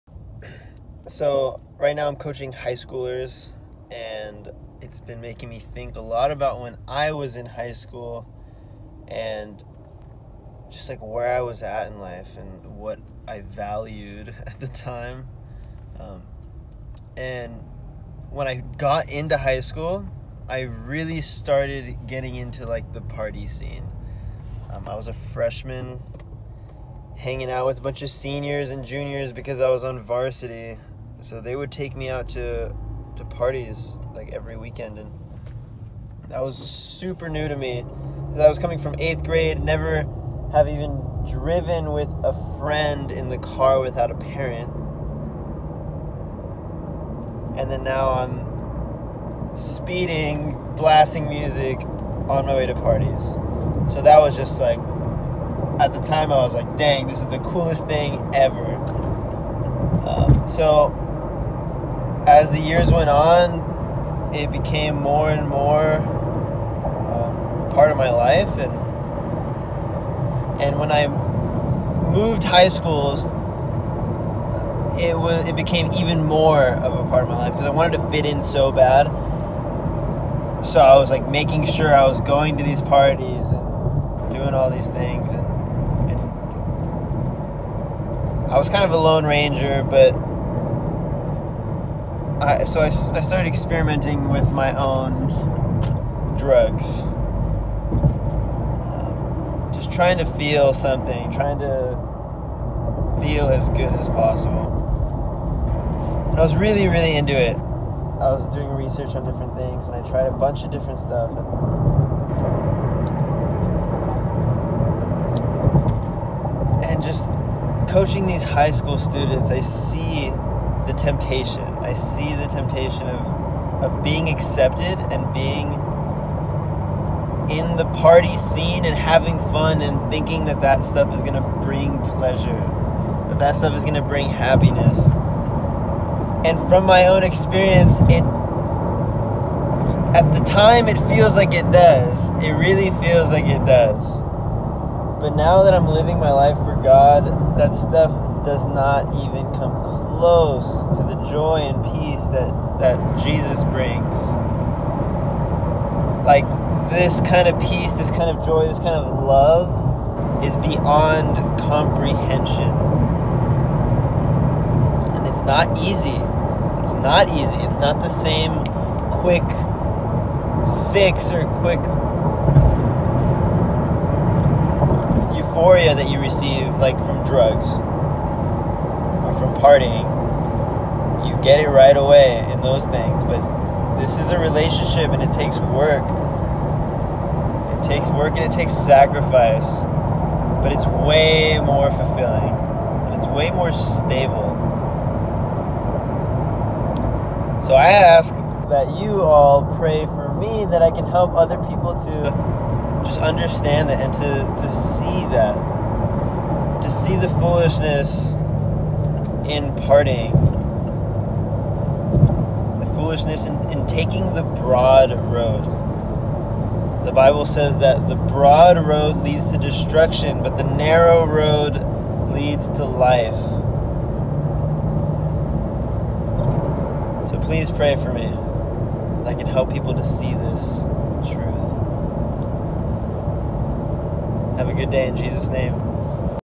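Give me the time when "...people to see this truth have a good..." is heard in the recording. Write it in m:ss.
3:49.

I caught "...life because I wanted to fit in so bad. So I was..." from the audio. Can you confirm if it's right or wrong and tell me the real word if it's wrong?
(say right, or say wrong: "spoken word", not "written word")
right.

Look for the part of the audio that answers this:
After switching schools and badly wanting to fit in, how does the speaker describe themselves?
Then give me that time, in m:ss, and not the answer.
1:28.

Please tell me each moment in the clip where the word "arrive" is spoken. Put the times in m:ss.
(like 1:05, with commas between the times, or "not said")
not said.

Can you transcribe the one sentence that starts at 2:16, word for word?
And from my own experience, it at the time it feels like it does.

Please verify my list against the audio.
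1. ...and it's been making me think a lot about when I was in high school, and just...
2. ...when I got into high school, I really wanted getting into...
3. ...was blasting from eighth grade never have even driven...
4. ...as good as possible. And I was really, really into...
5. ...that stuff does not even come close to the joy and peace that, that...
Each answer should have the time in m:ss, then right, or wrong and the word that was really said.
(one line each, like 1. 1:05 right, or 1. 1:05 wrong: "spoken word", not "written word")
1. 0:03 right
2. 0:18 wrong: "started", not "wanted"
3. 0:38 wrong: "coming", not "blasting"
4. 1:43 right
5. 2:27 right.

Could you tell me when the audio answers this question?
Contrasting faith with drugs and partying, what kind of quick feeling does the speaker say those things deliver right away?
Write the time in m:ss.
2:51.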